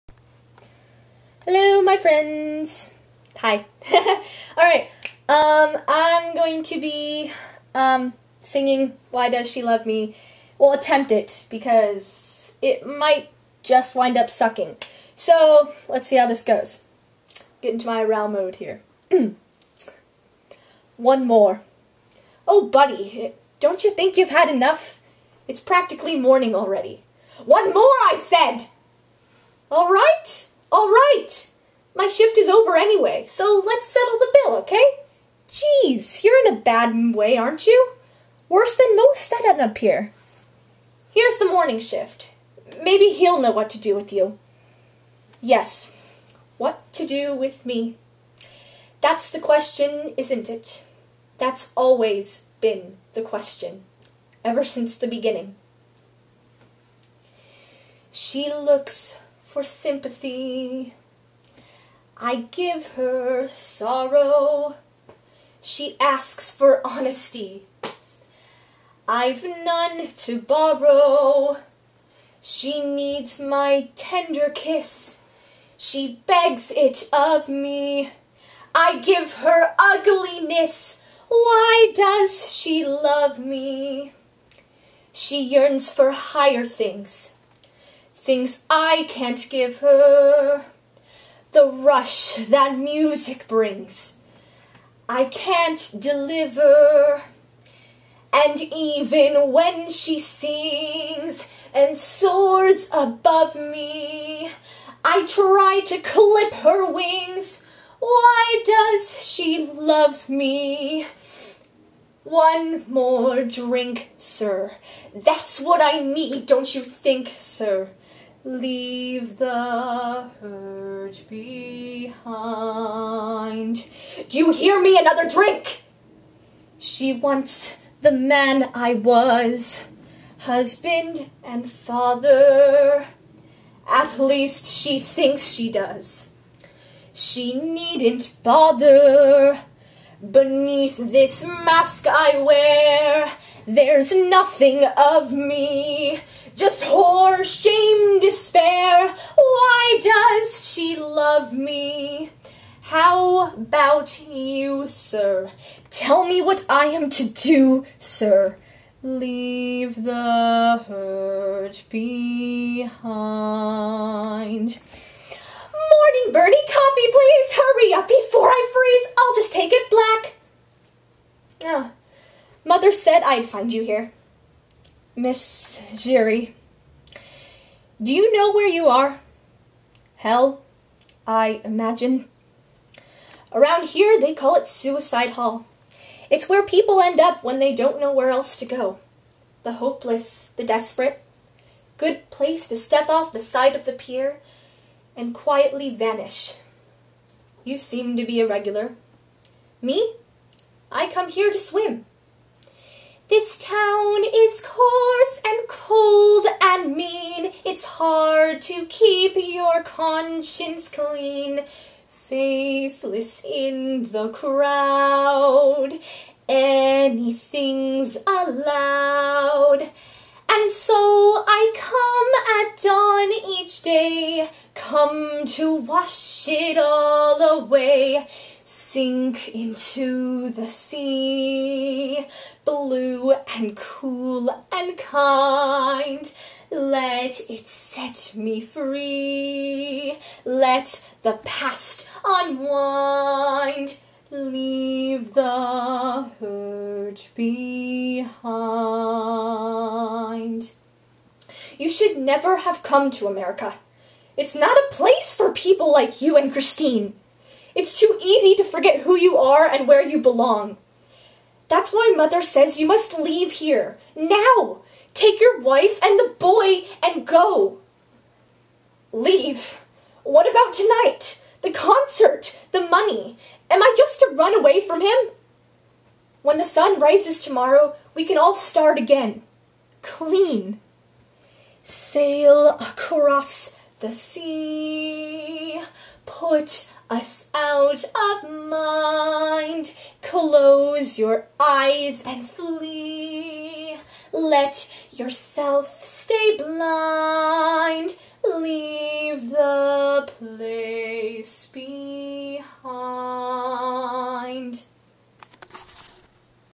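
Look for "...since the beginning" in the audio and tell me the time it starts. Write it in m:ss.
0:54.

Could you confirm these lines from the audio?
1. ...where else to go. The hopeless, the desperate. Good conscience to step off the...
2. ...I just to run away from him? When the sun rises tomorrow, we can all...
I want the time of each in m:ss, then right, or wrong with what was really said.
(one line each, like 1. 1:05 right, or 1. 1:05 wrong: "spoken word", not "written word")
1. 3:08 wrong: "place", not "conscience"
2. 4:33 right.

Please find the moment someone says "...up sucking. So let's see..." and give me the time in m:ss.
0:14.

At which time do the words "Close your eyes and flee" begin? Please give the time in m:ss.
4:50.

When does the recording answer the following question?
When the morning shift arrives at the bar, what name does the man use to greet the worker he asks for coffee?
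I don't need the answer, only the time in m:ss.
2:46.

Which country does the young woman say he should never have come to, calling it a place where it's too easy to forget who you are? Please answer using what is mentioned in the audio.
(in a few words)
America.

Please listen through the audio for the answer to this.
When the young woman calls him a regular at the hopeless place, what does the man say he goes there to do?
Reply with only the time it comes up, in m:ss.
3:21.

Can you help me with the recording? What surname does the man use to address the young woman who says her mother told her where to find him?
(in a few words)
Giry.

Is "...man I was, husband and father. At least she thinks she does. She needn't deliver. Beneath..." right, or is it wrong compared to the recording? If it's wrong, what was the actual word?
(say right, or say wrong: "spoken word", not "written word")
wrong: "bother", not "deliver".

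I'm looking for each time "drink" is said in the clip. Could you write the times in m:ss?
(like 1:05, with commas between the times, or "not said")
1:53, 2:05.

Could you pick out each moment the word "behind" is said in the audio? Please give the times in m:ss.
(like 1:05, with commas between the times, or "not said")
2:01, 2:41, 4:07.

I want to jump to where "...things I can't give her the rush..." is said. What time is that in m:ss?
1:28.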